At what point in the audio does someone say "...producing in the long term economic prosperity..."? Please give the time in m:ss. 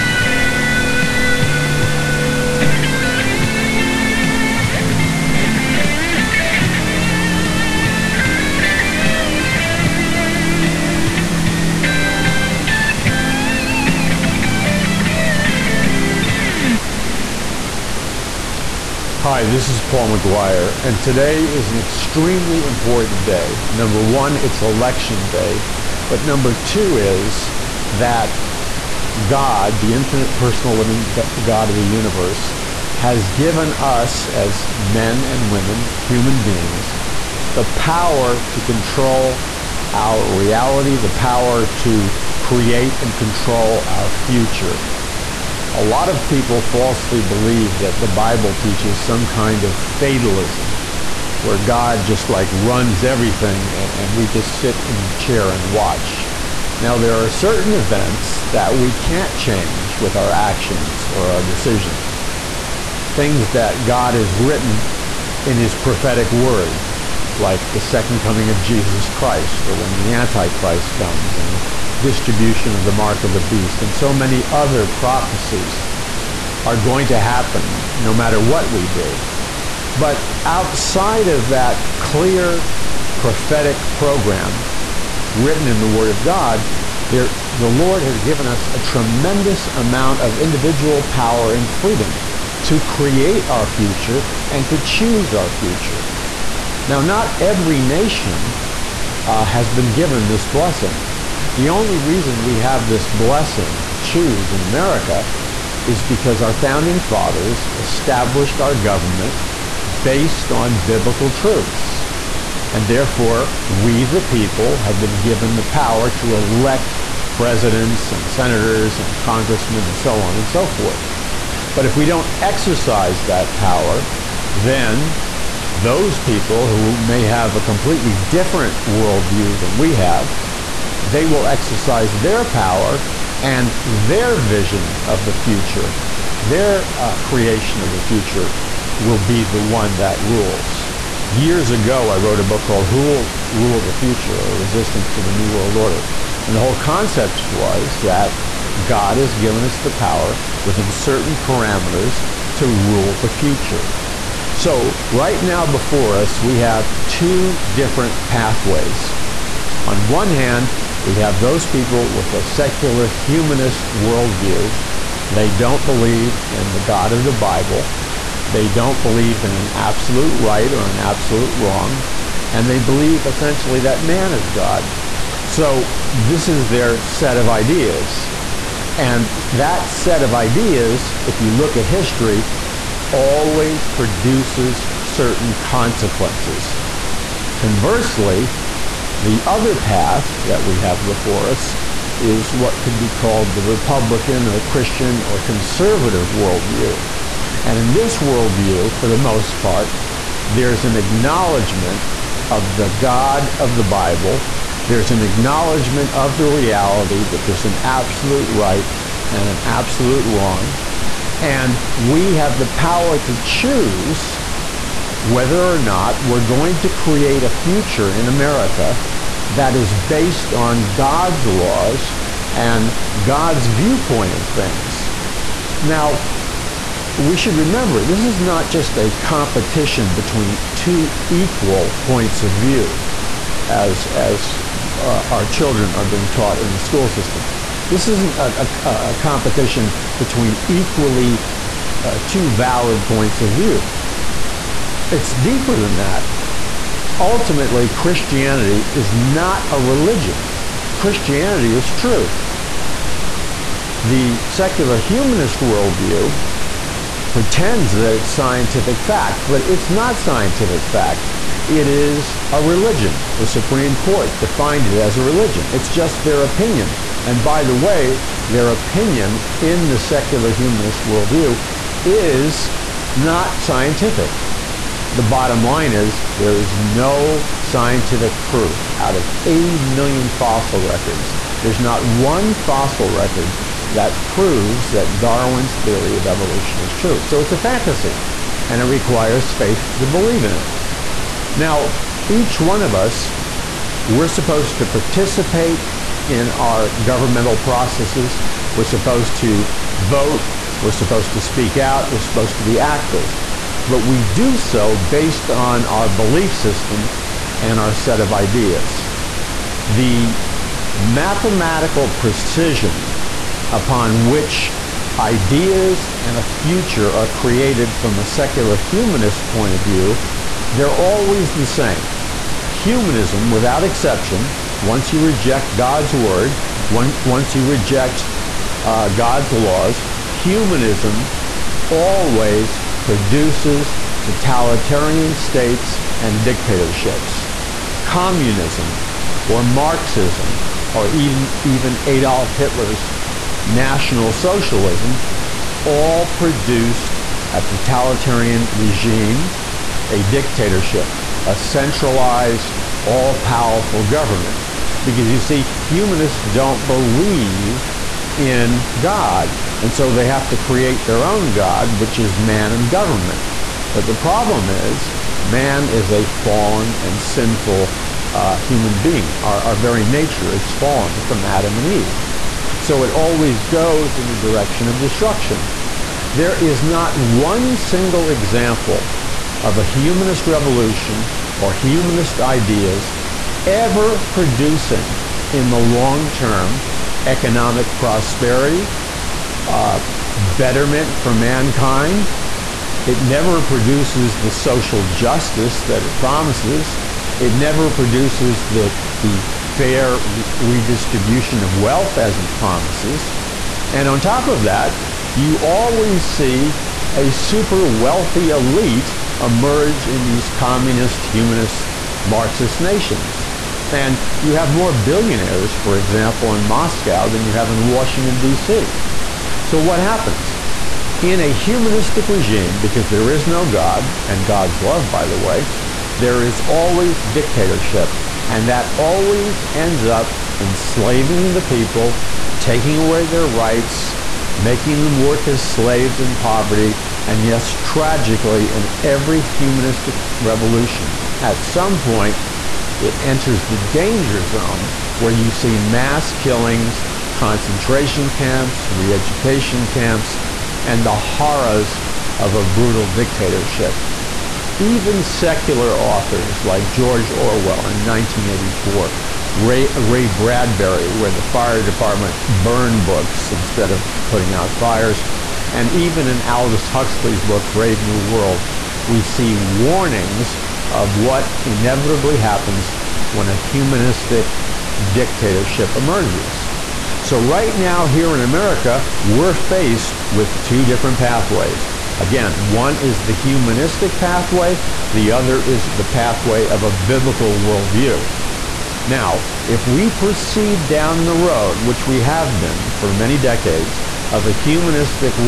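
6:24.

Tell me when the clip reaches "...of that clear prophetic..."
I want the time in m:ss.
1:21.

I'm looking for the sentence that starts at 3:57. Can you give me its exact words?
This isn't a, a, a competition between equally uh, two valid points of view.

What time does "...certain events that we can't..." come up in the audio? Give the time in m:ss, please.
0:57.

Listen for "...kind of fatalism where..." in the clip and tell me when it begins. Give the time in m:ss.
0:49.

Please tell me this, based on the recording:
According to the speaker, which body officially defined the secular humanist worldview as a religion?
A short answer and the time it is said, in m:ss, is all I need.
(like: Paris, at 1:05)
The Supreme Court, at 4:23.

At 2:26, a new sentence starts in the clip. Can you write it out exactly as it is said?
And the whole concept was that God has given us the power within certain parameters to rule the future.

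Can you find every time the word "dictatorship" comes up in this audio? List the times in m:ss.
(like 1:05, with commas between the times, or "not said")
5:36, 5:50, 7:07, 7:33, 7:55.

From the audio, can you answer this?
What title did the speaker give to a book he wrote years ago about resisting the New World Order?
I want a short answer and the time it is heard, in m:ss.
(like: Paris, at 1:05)
Who Will Rule the Future, at 2:22.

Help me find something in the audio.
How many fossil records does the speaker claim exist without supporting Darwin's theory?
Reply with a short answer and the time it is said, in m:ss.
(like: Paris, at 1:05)
80 million, at 4:39.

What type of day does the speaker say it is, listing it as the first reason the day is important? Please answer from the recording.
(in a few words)
Election day.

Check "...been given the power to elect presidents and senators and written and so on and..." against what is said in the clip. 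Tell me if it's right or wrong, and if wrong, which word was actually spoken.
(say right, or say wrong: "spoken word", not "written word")
wrong: "congressmen", not "written".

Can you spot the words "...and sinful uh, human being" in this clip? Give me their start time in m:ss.
6:07.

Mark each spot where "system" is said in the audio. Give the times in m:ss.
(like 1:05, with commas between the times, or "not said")
3:57, 5:06.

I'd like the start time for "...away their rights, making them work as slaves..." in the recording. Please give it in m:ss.
7:12.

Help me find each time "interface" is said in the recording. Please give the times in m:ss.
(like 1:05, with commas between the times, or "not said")
not said.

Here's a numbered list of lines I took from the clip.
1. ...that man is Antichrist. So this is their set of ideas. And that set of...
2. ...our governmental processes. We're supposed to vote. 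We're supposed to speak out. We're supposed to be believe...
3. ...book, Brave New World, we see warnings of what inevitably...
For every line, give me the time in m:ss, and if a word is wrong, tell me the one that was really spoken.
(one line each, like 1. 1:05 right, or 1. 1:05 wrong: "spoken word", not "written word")
1. 2:53 wrong: "God", not "Antichrist"
2. 4:56 wrong: "active", not "believe"
3. 7:47 right.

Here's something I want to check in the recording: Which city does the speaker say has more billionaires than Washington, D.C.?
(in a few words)
Moscow.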